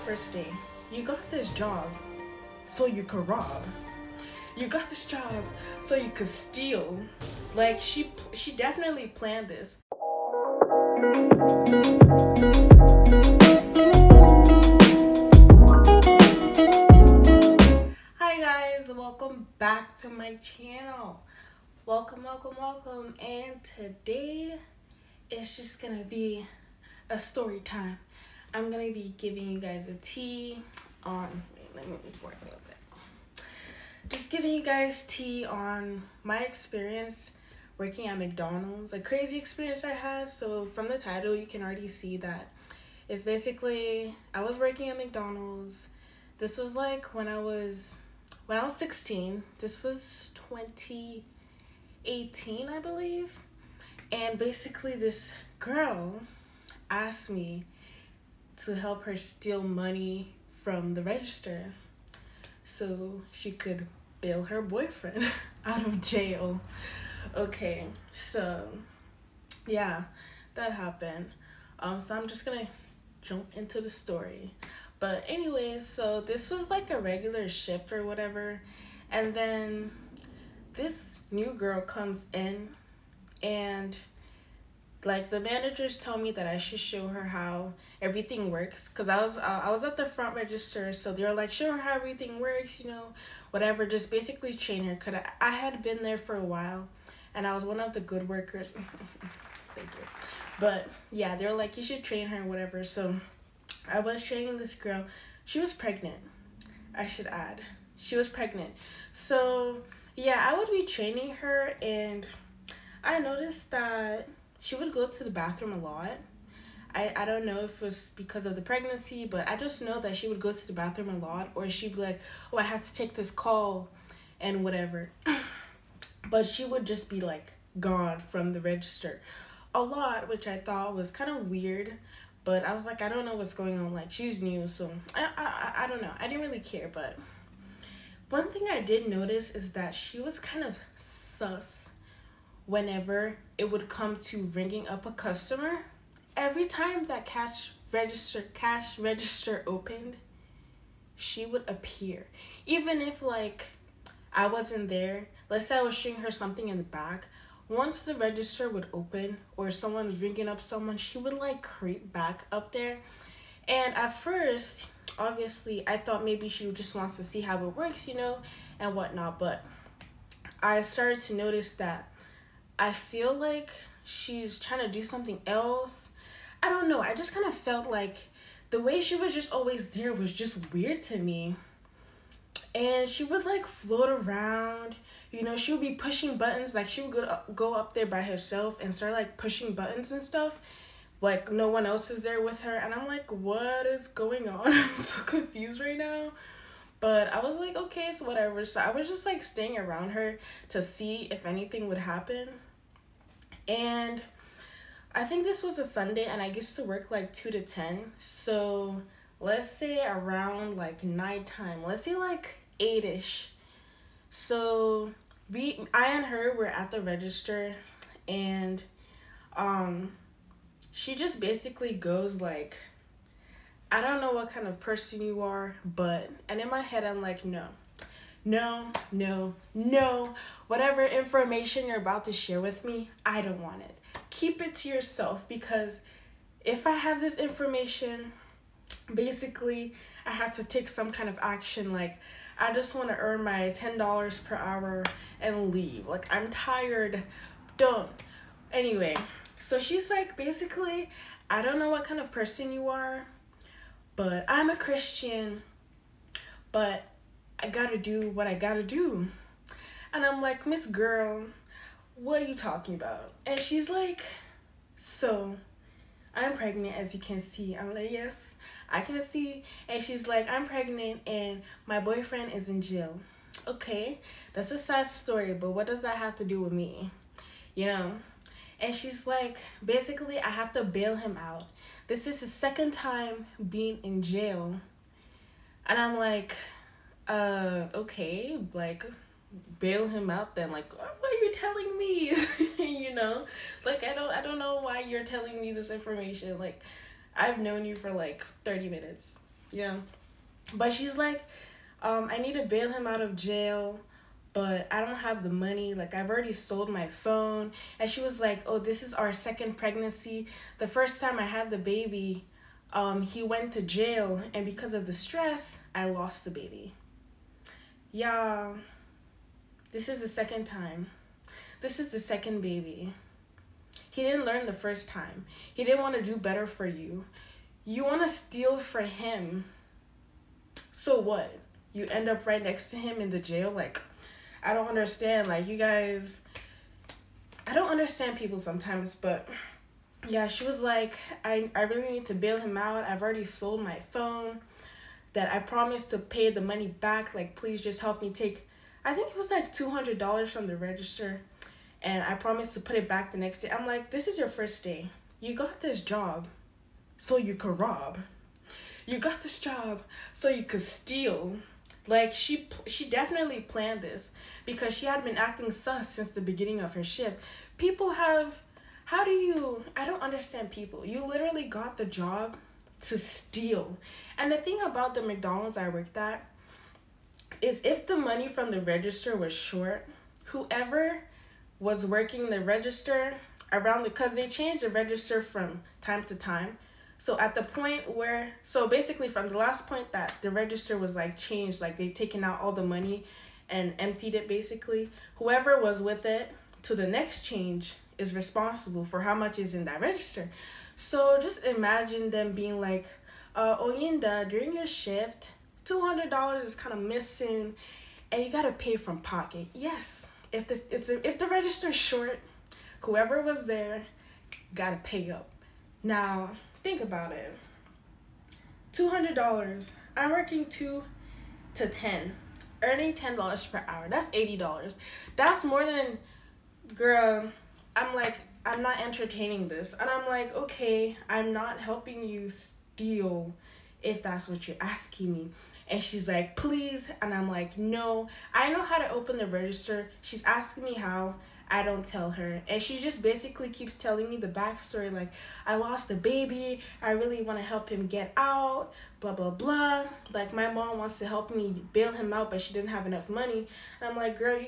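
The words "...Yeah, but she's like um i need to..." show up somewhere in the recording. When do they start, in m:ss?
4:59.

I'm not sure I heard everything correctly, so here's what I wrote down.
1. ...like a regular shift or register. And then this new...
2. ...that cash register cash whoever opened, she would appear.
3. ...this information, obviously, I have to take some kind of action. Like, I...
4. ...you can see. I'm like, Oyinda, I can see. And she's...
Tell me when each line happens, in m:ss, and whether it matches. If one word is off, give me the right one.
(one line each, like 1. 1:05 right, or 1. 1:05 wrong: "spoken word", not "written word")
1. 1:16 wrong: "whatever", not "register"
2. 2:27 wrong: "register", not "whoever"
3. 3:57 wrong: "basically", not "obviously"
4. 4:27 wrong: "Yes", not "Oyinda".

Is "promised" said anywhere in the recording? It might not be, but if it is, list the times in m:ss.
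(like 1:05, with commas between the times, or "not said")
5:45, 5:52.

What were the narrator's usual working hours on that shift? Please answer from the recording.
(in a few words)
2 to 10.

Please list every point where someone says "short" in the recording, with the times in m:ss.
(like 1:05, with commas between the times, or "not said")
6:19, 6:51.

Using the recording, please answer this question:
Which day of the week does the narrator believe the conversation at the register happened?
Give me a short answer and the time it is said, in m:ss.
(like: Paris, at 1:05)
Sunday, at 3:25.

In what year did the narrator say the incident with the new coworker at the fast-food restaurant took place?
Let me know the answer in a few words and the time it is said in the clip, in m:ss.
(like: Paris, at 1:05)
2018, at 0:50.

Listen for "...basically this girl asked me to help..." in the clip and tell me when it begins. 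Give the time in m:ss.
0:54.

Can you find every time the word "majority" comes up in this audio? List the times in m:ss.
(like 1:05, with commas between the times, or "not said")
not said.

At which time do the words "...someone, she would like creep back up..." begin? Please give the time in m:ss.
2:40.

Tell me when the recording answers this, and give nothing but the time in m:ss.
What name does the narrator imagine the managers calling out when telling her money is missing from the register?
6:43.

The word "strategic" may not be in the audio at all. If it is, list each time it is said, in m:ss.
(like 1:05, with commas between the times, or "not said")
not said.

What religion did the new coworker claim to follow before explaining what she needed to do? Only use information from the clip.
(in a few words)
Christian.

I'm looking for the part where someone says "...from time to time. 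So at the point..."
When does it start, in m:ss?
6:25.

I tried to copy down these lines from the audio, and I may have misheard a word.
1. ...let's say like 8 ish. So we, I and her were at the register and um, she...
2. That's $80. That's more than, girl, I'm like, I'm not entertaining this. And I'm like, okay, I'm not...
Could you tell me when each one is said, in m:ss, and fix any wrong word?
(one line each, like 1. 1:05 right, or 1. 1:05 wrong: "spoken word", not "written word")
1. 3:31 right
2. 7:04 right.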